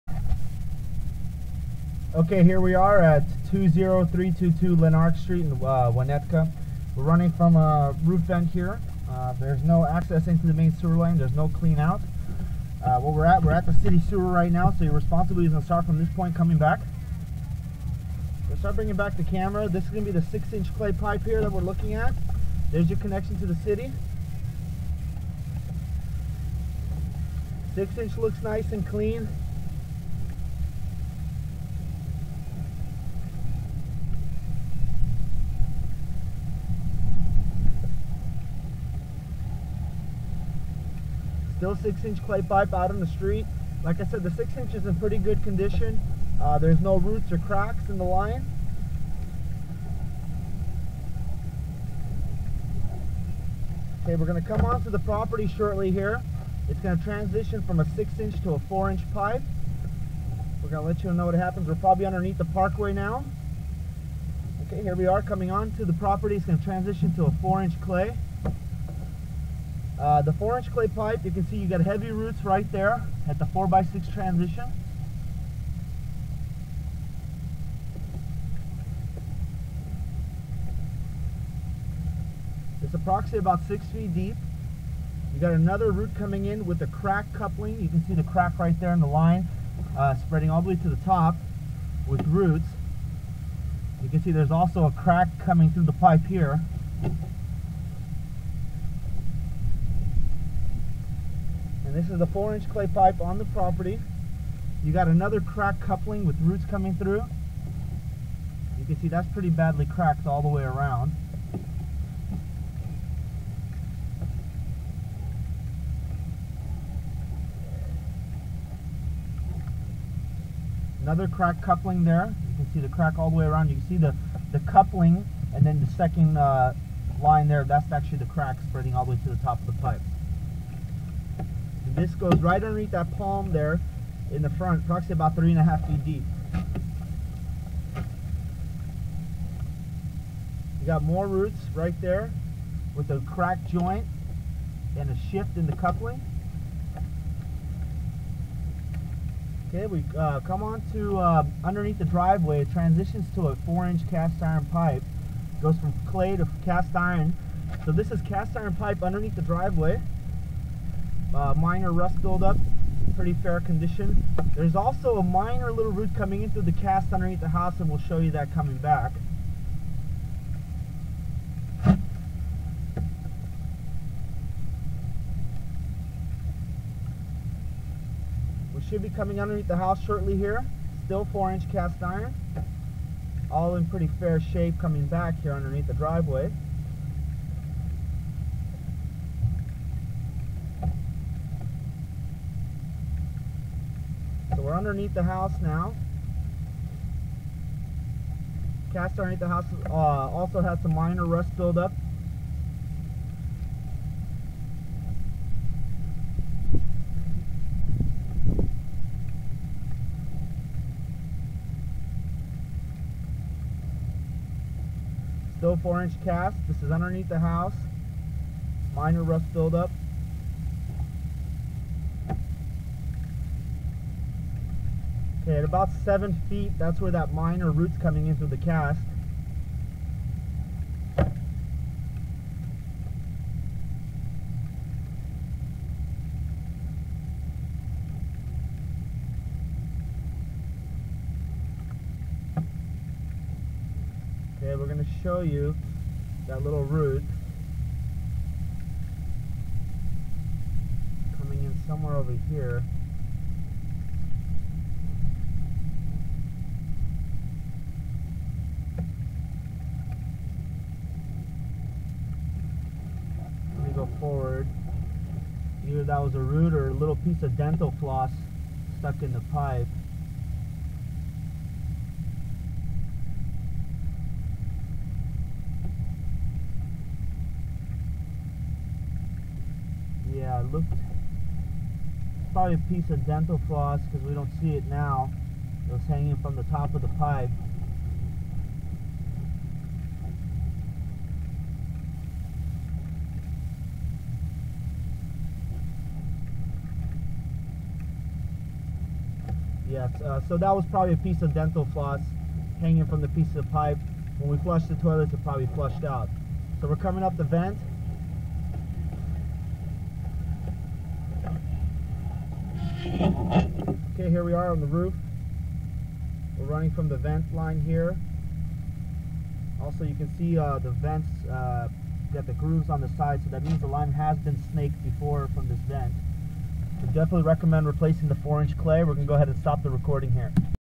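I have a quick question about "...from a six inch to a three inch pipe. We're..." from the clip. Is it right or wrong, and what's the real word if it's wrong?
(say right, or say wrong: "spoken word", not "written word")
wrong: "four", not "three".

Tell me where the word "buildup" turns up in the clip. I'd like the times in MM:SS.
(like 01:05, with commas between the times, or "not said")
02:42, 03:21, 03:39.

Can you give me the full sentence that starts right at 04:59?
Yes, uh, so that was probably a piece of dental floss hanging from the piece of pipe.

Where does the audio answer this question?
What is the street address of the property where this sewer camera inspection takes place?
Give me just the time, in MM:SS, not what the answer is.
00:03.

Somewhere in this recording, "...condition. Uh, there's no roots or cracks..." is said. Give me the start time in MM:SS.
00:45.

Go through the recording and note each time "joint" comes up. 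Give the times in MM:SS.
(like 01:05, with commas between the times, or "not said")
02:23.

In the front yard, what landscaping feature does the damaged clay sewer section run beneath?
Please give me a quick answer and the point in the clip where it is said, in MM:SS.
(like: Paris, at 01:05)
palm, at 02:13.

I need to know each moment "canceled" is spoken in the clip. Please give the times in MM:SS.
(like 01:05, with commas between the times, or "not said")
not said.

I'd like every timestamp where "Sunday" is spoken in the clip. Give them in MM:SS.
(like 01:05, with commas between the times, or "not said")
not said.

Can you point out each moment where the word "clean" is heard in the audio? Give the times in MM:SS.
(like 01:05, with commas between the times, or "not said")
00:11, 00:28.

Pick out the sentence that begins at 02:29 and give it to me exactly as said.
Okay, we uh, come on to uh, underneath the driveway.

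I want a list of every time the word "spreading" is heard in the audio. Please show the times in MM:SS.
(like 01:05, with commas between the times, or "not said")
01:30, 02:08.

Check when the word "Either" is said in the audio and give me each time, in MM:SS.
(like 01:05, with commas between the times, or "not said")
04:25.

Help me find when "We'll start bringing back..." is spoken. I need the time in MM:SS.
00:18.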